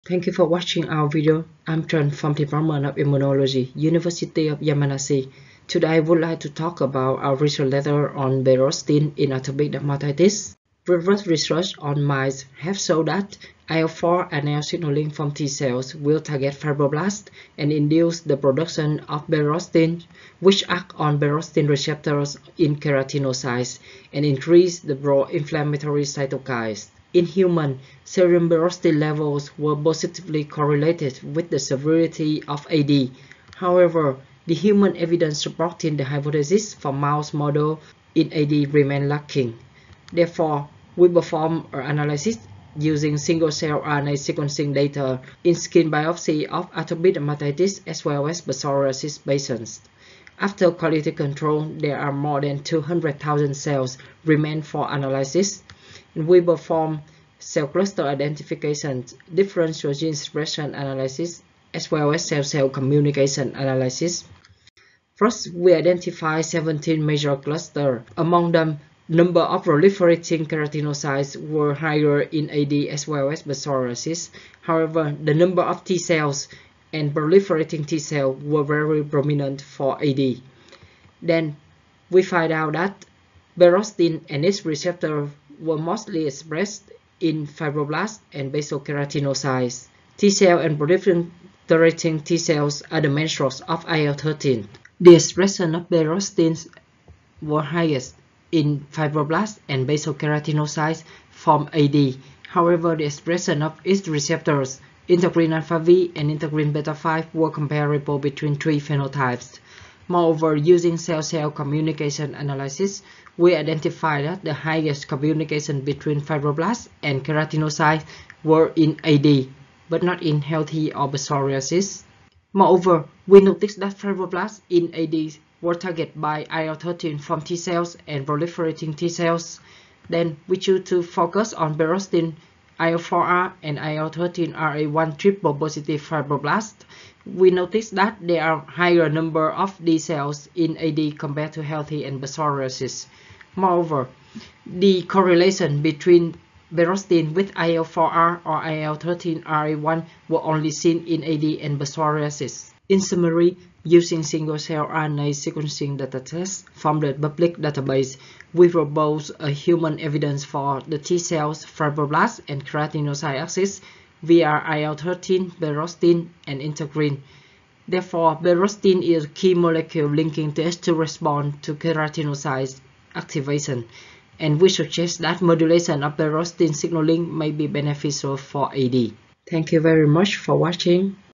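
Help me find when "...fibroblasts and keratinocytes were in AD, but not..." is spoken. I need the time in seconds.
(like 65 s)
116 s.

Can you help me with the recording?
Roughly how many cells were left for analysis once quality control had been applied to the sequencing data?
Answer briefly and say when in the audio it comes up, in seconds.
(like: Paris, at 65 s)
more than 200,000, at 52 s.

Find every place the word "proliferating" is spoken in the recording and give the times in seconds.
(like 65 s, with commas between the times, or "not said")
69 s, 77 s, 90 s, 128 s.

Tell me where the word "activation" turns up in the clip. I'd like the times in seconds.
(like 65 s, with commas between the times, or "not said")
173 s.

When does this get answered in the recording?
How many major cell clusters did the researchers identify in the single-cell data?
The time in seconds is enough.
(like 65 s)
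66 s.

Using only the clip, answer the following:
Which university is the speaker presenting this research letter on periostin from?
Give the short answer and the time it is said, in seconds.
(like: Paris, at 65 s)
University of Yamanashi, at 3 s.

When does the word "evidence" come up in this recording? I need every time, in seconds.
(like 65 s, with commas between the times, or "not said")
34 s, 159 s.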